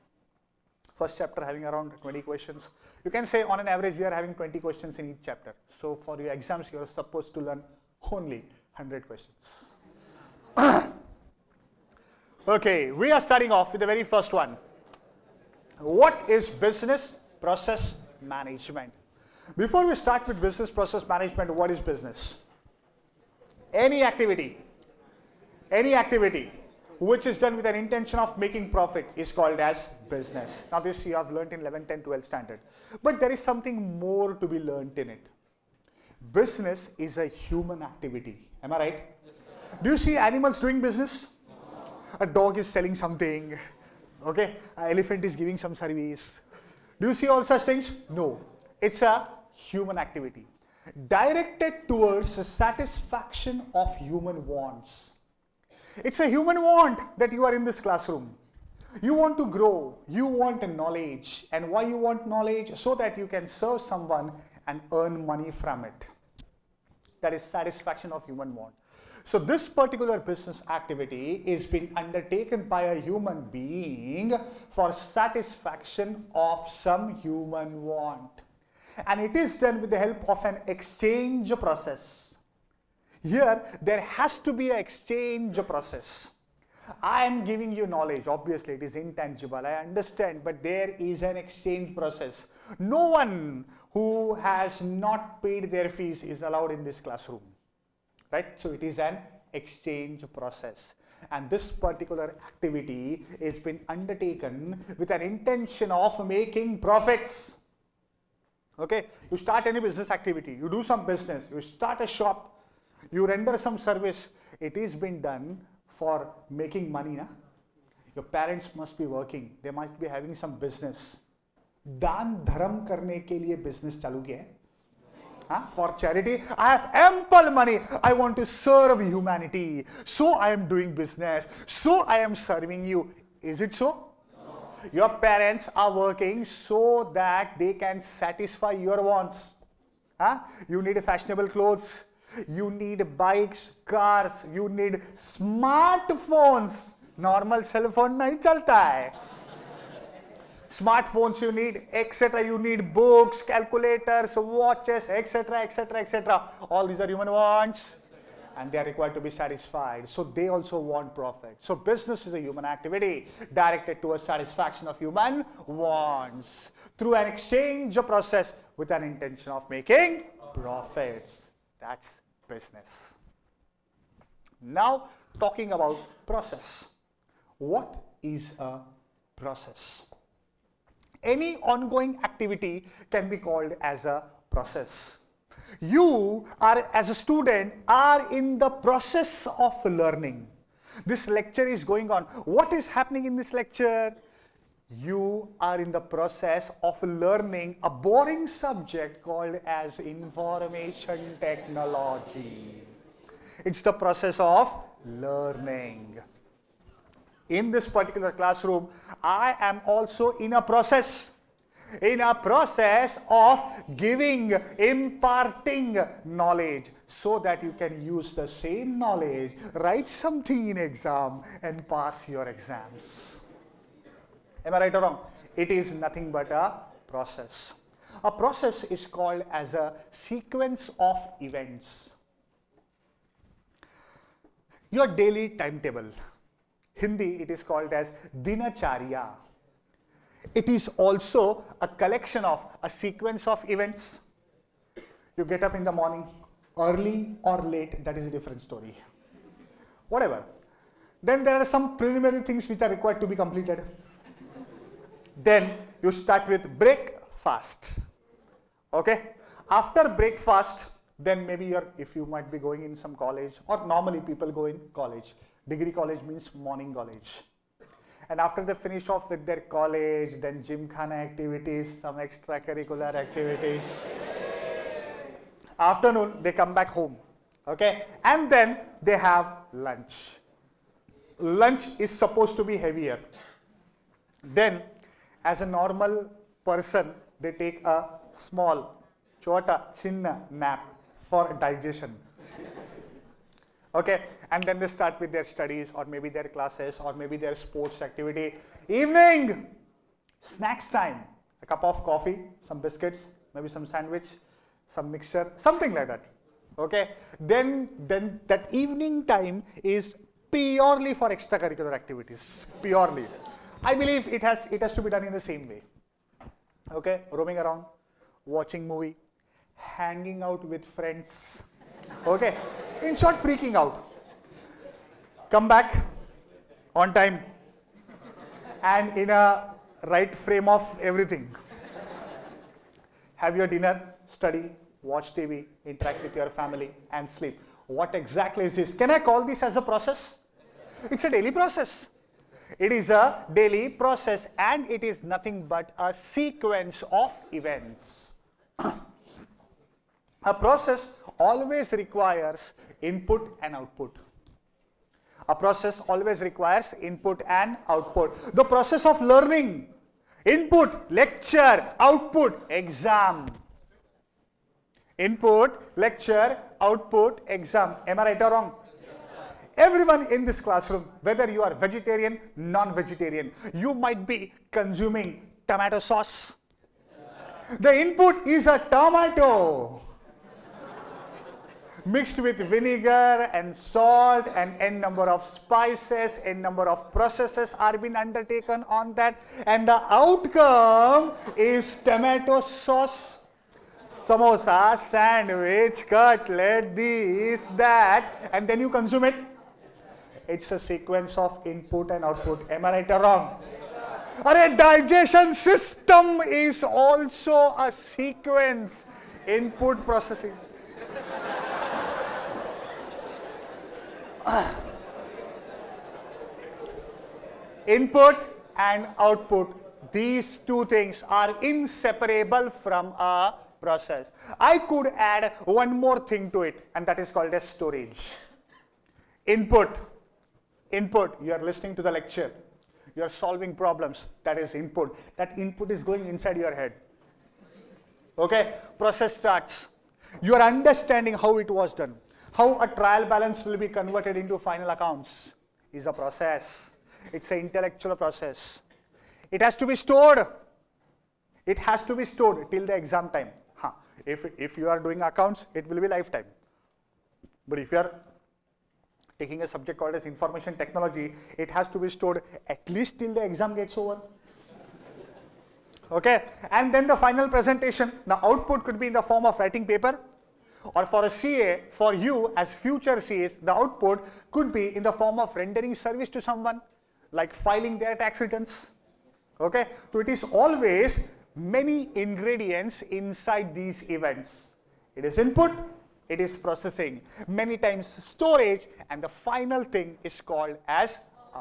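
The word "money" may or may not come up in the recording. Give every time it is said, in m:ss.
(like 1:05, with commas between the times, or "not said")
1:05, 1:56, 2:07.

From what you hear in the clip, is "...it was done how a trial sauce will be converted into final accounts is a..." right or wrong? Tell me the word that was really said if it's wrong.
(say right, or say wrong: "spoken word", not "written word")
wrong: "balance", not "sauce".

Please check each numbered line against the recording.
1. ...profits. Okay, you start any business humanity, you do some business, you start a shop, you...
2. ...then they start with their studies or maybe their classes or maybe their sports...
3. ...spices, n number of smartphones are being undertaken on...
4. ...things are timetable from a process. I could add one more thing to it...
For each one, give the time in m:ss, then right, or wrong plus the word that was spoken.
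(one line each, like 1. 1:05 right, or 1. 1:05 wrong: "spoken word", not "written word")
1. 1:46 wrong: "activity", not "humanity"
2. 4:54 right
3. 6:25 wrong: "processes", not "smartphones"
4. 7:00 wrong: "inseparable", not "timetable".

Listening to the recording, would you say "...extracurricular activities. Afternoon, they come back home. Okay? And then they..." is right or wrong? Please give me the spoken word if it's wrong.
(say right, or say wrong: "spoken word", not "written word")
right.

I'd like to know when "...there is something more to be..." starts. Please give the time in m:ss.
0:33.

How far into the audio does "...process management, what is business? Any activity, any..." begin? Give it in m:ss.
0:20.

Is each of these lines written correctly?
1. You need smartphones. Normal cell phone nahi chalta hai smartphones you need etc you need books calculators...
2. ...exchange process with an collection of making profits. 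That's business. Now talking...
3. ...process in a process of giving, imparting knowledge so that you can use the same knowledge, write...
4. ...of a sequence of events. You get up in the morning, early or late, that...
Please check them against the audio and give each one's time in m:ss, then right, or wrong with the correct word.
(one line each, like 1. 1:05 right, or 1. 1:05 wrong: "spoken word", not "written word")
1. 2:24 right
2. 2:47 wrong: "intention", not "collection"
3. 3:30 right
4. 4:02 right.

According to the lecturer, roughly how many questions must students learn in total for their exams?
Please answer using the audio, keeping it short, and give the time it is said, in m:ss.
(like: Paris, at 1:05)
100, at 0:08.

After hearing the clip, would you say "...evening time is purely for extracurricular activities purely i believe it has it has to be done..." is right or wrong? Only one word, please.
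right.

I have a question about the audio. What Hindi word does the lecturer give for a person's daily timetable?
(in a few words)
Dinacharya.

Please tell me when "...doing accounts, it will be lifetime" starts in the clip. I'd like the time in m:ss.
7:34.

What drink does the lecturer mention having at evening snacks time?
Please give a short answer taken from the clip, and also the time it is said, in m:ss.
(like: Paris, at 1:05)
Coffee, at 5:01.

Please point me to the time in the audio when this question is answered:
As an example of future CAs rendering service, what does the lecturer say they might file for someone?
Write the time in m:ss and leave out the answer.
7:58.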